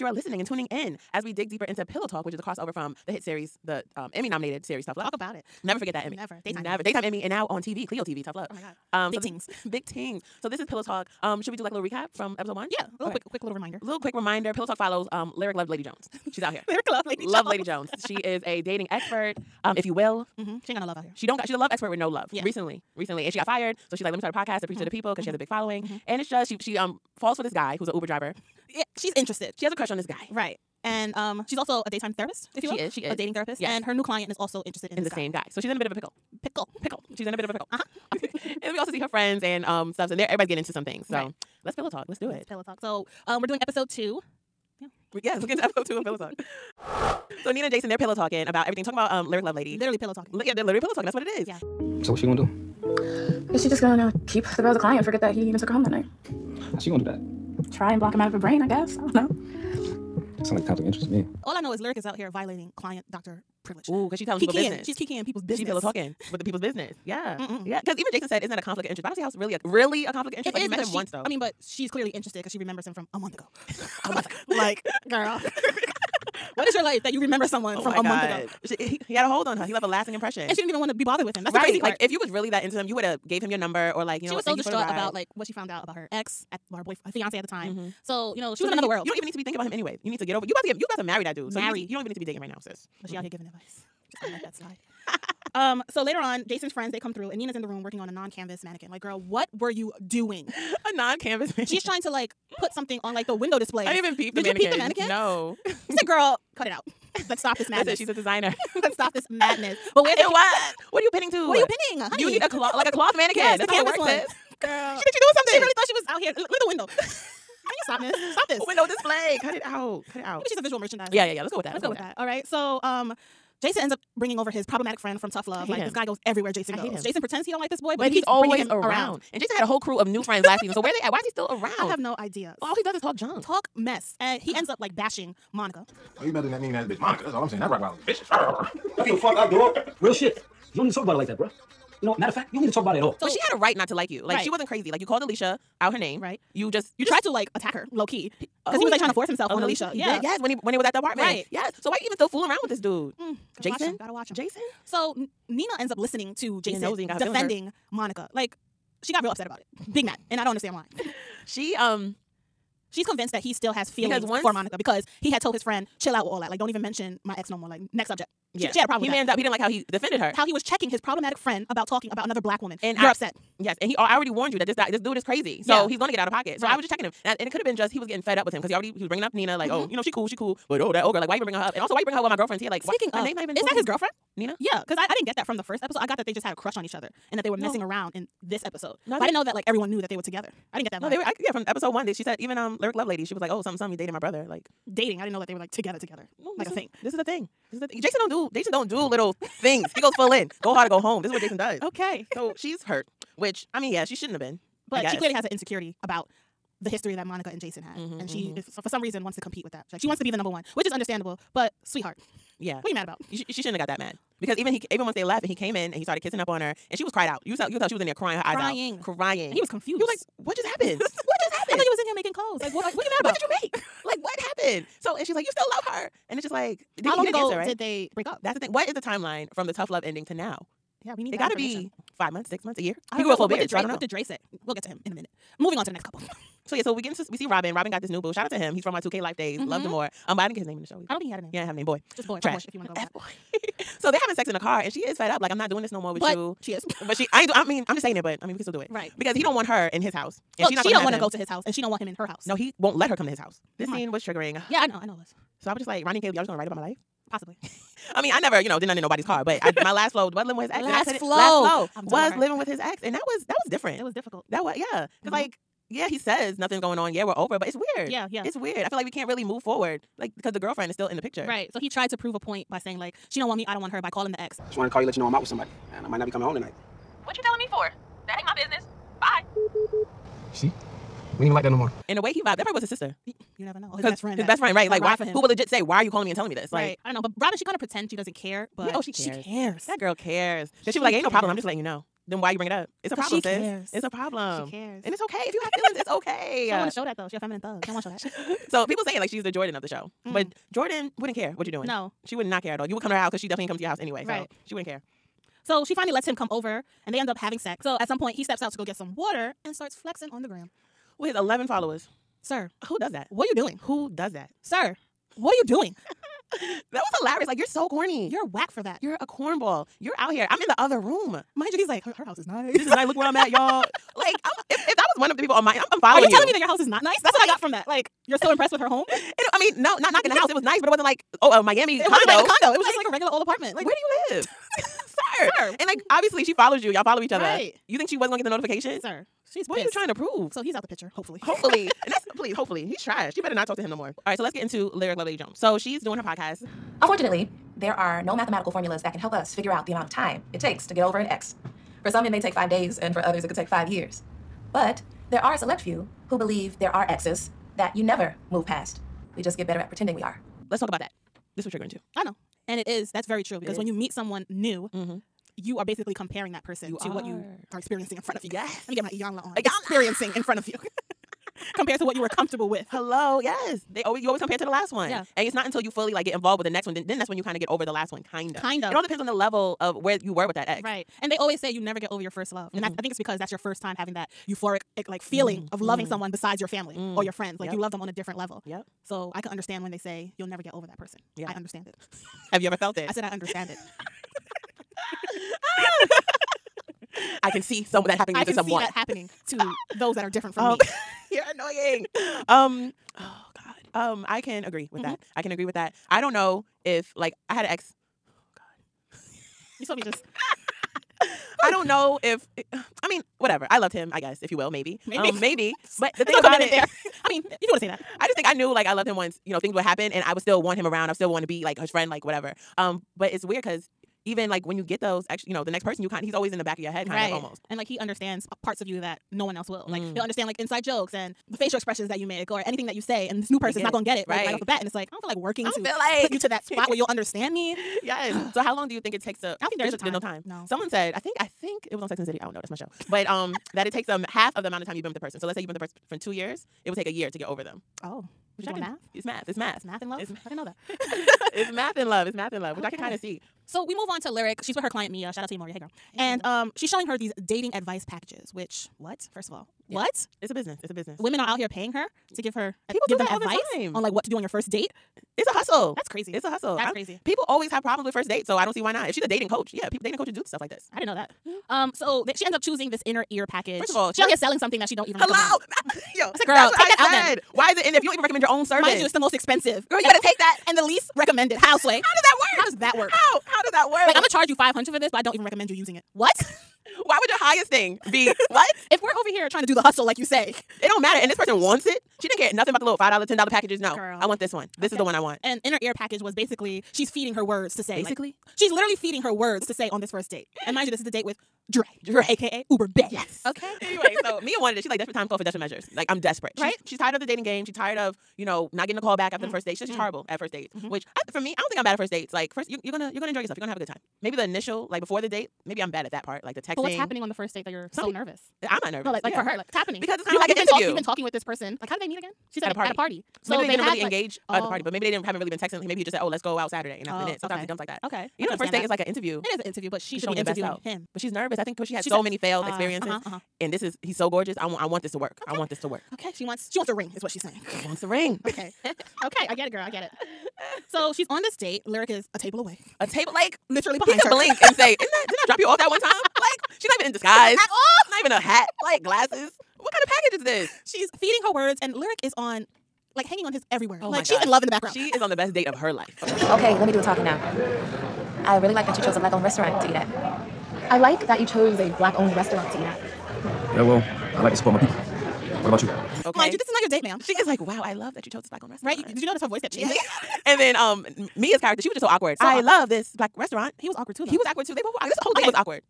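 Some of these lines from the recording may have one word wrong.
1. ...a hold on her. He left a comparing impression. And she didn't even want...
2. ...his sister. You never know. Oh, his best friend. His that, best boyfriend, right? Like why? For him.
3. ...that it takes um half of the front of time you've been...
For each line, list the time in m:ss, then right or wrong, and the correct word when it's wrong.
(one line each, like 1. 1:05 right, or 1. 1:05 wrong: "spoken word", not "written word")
1. 1:19 wrong: "lasting", not "comparing"
2. 4:42 wrong: "friend", not "boyfriend"
3. 7:23 wrong: "amount", not "front".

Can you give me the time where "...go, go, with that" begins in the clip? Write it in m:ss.
2:01.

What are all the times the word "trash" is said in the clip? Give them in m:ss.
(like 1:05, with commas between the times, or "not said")
4:02, 5:43.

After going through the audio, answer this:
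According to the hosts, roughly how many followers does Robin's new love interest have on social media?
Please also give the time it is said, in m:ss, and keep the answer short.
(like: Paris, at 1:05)
11, at 5:11.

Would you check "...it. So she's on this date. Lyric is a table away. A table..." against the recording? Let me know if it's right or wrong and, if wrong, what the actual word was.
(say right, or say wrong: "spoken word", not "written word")
right.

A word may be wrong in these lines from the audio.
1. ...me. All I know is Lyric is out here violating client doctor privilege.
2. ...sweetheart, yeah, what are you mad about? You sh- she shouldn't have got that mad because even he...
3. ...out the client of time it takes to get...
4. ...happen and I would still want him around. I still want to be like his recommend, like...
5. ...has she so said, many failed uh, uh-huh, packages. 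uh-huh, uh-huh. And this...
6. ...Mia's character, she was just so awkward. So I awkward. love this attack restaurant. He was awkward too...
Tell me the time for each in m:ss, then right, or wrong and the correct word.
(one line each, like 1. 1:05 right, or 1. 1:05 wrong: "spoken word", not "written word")
1. 1:01 right
2. 3:31 right
3. 5:49 wrong: "amount", not "client"
4. 6:59 wrong: "friend", not "recommend"
5. 8:51 wrong: "experiences", not "packages"
6. 9:31 wrong: "black", not "attack".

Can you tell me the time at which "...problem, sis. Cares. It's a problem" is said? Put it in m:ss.
4:53.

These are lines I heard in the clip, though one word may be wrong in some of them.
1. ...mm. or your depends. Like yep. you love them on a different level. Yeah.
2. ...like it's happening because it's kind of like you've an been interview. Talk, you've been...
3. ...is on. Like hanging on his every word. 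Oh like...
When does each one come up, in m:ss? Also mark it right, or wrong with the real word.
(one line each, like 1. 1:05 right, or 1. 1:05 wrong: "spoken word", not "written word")
1. 6:26 wrong: "friends", not "depends"
2. 8:39 right
3. 9:12 right.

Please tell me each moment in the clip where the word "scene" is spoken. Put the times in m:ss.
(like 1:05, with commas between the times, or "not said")
4:13.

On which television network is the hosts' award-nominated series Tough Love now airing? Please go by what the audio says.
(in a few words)
Cleo TV.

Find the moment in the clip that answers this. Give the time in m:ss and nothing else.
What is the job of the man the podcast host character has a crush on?
0:27.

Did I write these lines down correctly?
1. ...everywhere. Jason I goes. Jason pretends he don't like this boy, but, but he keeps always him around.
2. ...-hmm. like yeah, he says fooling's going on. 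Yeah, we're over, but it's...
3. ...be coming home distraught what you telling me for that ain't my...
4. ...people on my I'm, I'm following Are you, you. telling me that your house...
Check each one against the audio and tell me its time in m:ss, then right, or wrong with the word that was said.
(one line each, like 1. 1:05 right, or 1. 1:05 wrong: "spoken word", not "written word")
1. 2:06 right
2. 4:25 wrong: "nothing", not "fooling"
3. 4:36 wrong: "tonight", not "distraught"
4. 5:25 right.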